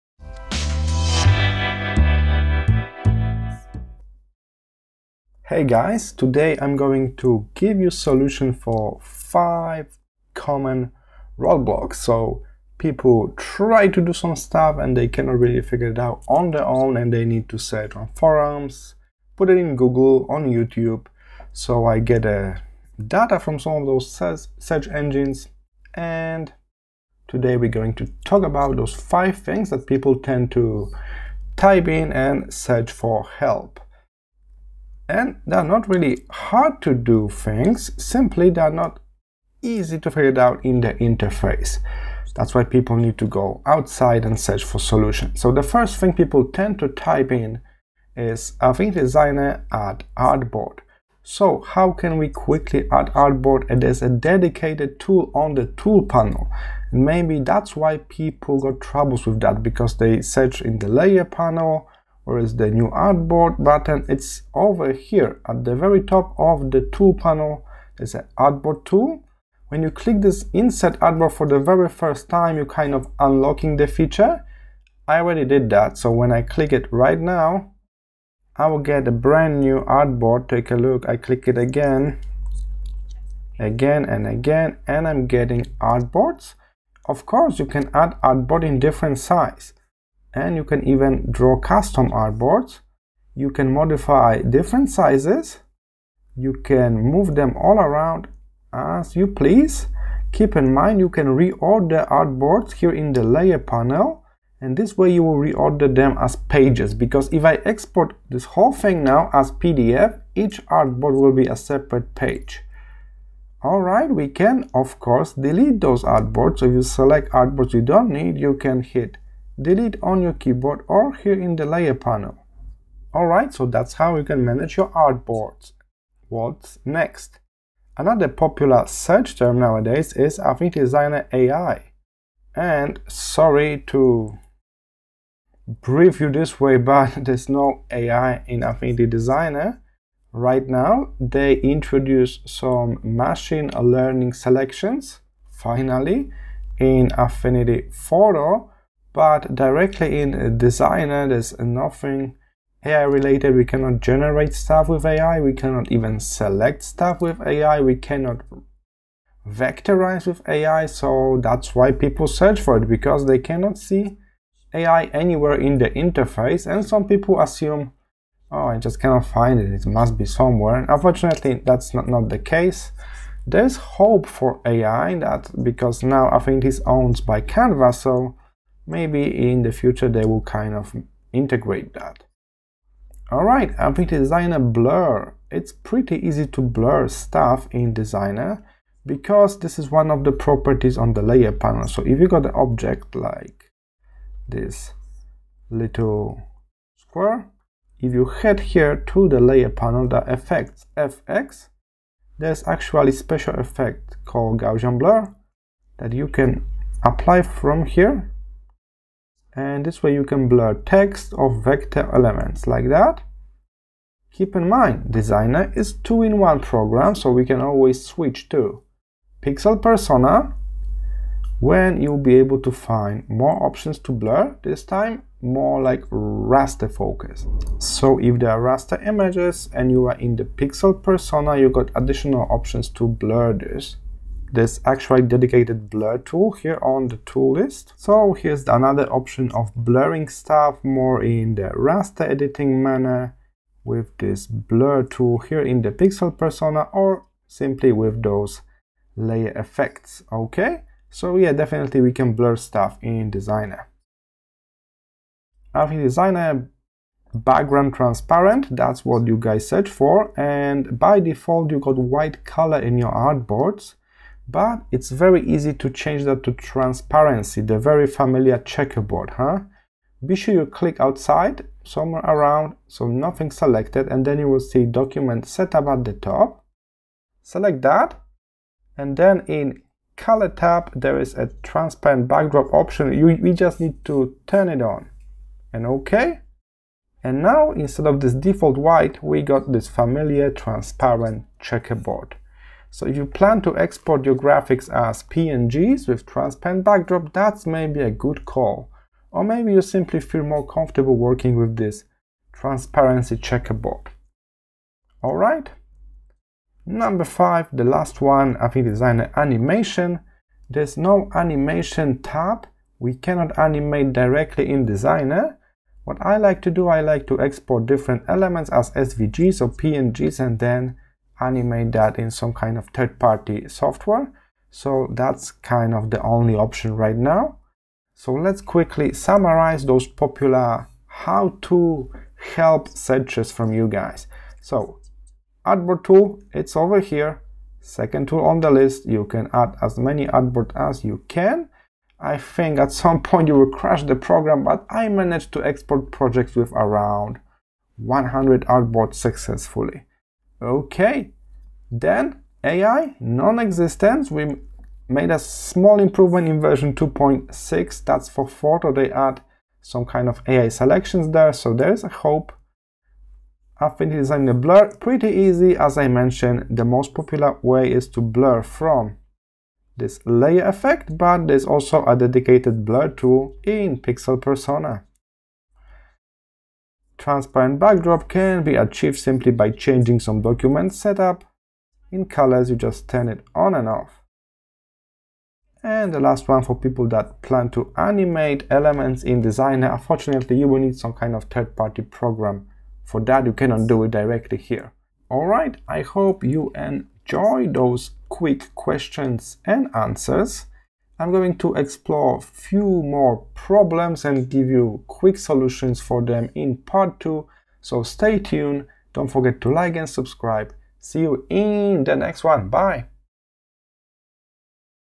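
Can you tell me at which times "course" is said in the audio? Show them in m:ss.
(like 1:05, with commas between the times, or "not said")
1:27, 1:54.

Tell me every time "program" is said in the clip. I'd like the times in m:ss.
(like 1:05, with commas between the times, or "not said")
3:36, 5:44, 6:32.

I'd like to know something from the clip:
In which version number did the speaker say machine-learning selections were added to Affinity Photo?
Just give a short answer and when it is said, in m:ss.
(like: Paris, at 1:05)
2.6, at 5:56.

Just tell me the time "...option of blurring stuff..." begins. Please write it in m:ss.
3:59.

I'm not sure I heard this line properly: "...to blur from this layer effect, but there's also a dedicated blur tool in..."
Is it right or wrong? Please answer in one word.
right.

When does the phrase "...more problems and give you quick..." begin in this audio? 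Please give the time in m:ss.
6:43.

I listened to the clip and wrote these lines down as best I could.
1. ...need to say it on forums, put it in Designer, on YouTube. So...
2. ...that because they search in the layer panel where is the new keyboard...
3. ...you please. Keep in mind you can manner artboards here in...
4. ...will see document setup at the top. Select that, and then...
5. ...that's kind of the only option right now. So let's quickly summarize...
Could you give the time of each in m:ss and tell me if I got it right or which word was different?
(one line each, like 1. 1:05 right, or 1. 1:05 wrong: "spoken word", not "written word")
1. 0:17 wrong: "Google", not "Designer"
2. 0:59 wrong: "artboard", not "keyboard"
3. 1:39 wrong: "reorder", not "manner"
4. 4:34 right
5. 5:25 right.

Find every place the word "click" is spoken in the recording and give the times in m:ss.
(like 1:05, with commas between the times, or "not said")
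1:09, 1:16, 1:21, 4:30.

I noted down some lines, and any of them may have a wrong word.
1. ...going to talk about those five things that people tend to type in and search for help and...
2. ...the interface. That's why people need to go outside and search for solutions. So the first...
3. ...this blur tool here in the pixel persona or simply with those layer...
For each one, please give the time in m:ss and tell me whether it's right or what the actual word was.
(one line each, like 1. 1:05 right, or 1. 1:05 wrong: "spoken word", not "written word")
1. 0:27 right
2. 0:40 right
3. 4:04 right.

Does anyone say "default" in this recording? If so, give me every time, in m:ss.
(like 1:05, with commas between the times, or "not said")
4:21, 4:48.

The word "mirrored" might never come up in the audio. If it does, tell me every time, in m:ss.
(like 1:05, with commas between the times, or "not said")
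not said.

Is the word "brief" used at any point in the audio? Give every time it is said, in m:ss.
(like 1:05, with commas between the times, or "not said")
2:15.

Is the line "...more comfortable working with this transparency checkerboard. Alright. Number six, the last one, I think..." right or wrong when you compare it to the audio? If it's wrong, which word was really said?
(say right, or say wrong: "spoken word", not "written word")
wrong: "five", not "six".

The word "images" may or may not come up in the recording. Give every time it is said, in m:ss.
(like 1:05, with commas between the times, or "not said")
3:49.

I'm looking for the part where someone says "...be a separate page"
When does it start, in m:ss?
1:51.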